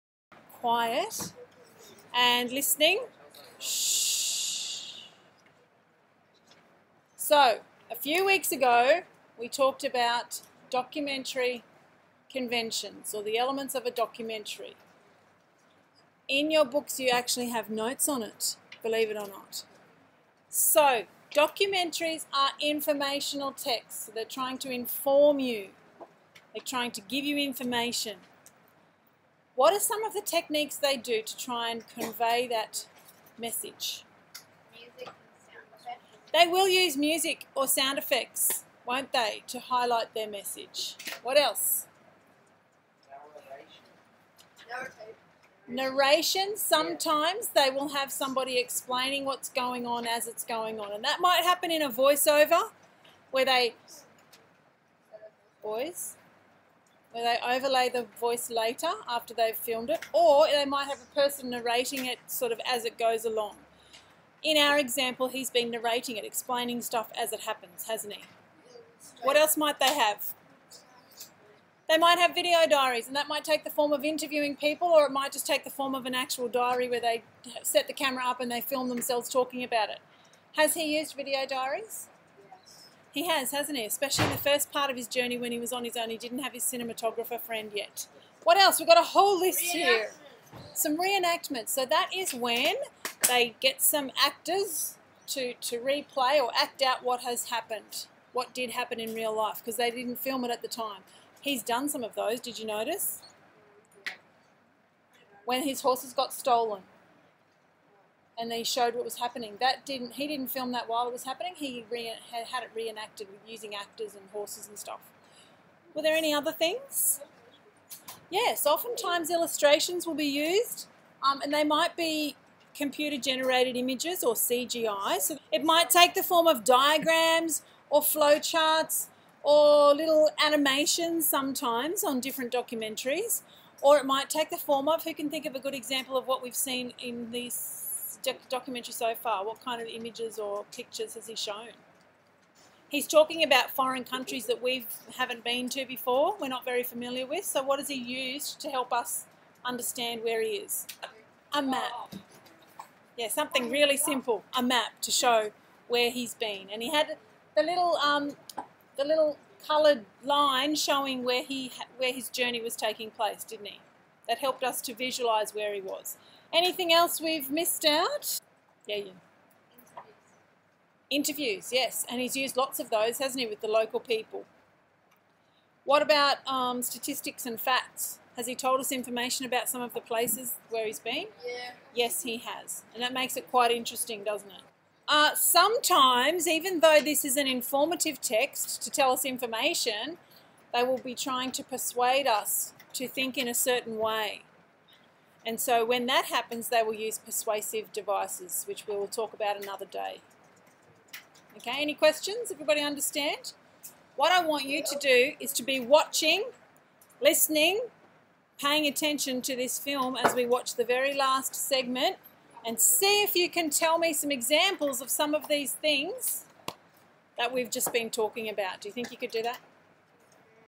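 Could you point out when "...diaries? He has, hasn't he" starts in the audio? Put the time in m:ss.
1:21.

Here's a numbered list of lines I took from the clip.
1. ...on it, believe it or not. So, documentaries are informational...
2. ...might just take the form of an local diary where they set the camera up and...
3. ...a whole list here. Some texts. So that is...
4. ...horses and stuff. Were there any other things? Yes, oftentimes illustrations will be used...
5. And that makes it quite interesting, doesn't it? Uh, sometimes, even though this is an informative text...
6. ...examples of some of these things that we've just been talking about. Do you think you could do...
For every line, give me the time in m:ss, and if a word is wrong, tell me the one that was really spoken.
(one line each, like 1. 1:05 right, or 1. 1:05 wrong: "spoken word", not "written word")
1. 0:18 right
2. 1:15 wrong: "actual", not "local"
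3. 1:28 wrong: "reenactments", not "texts"
4. 1:54 right
5. 3:02 right
6. 3:34 right.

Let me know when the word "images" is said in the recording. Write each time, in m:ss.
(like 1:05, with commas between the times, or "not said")
2:03, 2:19.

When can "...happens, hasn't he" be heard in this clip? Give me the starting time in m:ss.
1:07.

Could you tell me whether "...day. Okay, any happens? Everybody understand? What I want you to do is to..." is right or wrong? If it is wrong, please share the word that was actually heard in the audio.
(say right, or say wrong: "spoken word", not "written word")
wrong: "questions", not "happens".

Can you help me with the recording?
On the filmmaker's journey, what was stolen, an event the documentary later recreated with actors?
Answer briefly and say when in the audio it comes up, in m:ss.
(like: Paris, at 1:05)
His horses, at 1:45.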